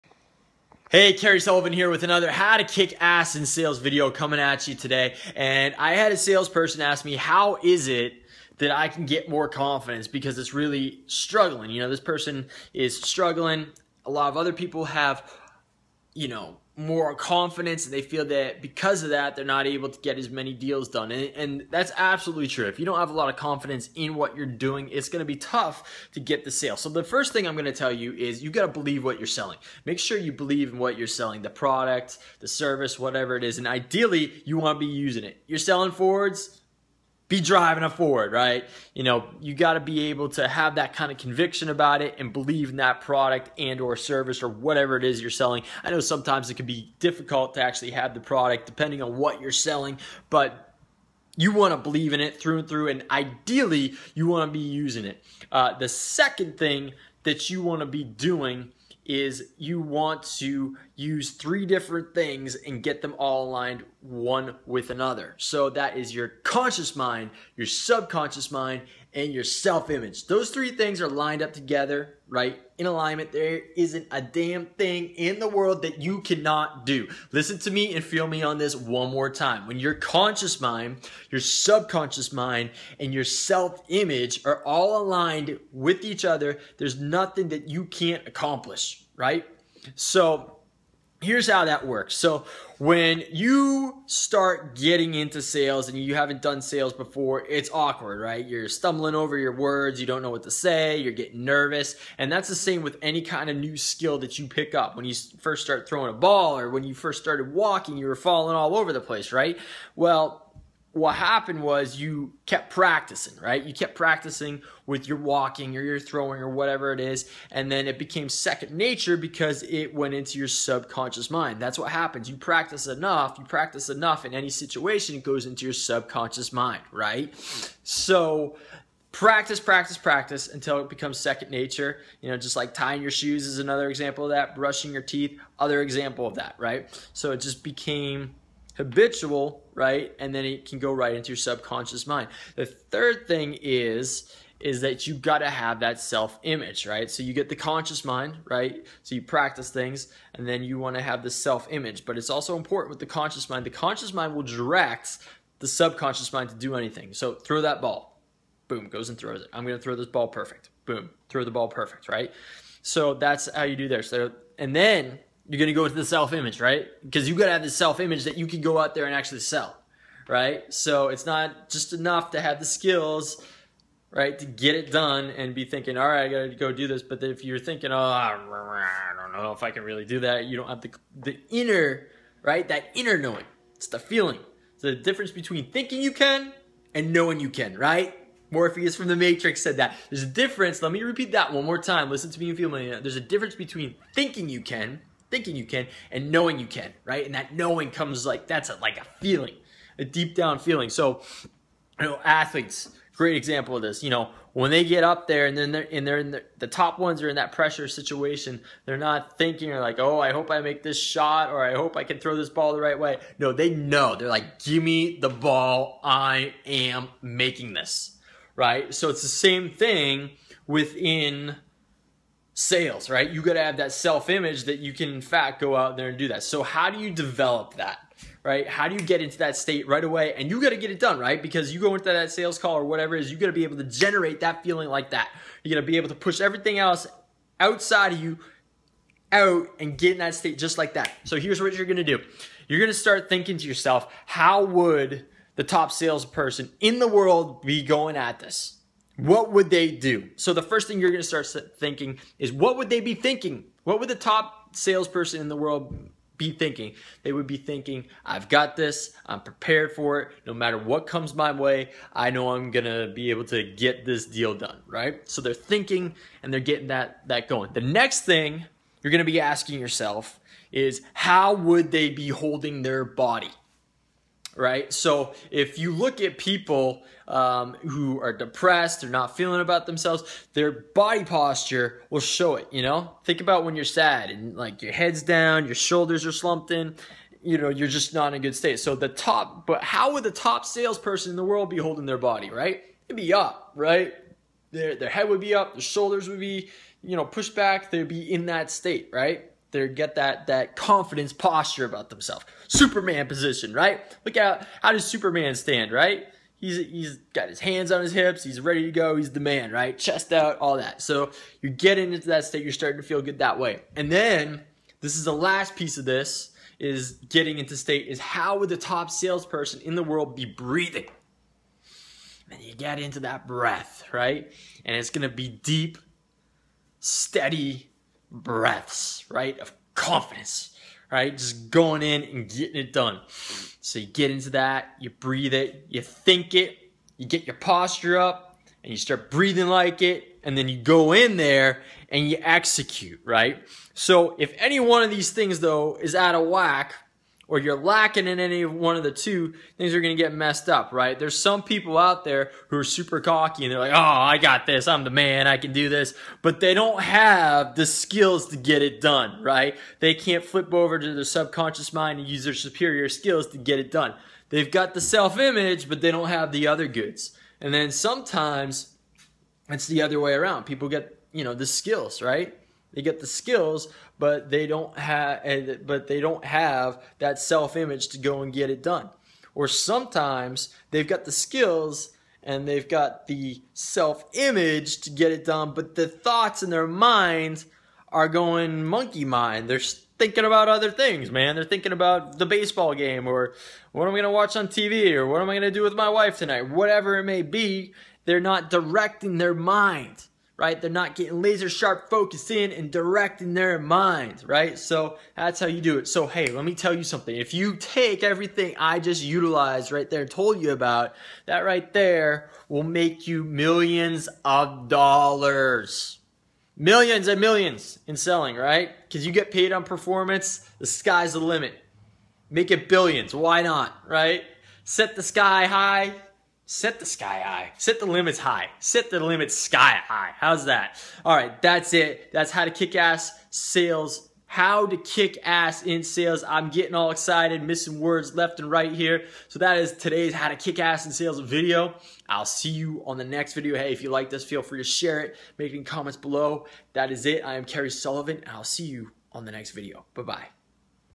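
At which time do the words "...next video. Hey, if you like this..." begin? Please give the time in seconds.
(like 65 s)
443 s.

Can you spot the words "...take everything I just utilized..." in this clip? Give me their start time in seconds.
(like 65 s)
407 s.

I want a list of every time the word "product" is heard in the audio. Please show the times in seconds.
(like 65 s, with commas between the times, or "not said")
31 s, 42 s, 48 s.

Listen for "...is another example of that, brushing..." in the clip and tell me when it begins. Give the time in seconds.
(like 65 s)
133 s.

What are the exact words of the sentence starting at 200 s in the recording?
So, you know, athletes, great example of this.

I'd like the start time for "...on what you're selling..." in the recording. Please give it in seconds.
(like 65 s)
49 s.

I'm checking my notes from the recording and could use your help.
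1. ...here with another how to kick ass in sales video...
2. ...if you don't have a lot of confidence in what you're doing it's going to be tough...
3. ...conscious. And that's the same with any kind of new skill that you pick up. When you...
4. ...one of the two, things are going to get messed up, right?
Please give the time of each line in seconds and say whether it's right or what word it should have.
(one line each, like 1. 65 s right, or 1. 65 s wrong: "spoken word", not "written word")
1. 1 s right
2. 22 s right
3. 101 s wrong: "nervous", not "conscious"
4. 348 s right.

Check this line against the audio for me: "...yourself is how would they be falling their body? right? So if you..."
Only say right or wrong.
wrong.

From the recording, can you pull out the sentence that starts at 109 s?
Well, what happened was you kept practicing, right?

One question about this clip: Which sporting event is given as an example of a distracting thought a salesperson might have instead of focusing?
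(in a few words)
baseball game.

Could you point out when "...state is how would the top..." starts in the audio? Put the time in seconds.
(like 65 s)
317 s.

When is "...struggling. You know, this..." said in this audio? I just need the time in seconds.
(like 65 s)
11 s.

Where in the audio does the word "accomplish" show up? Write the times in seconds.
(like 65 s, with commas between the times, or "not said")
88 s.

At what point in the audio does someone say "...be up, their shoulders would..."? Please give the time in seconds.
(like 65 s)
295 s.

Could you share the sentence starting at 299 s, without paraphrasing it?
they get that that confidence posture about themselves.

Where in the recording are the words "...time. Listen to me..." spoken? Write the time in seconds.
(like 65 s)
191 s.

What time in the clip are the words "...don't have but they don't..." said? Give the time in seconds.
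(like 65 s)
374 s.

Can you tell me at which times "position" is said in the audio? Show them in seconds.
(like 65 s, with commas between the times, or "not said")
303 s.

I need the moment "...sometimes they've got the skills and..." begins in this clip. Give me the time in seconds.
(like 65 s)
379 s.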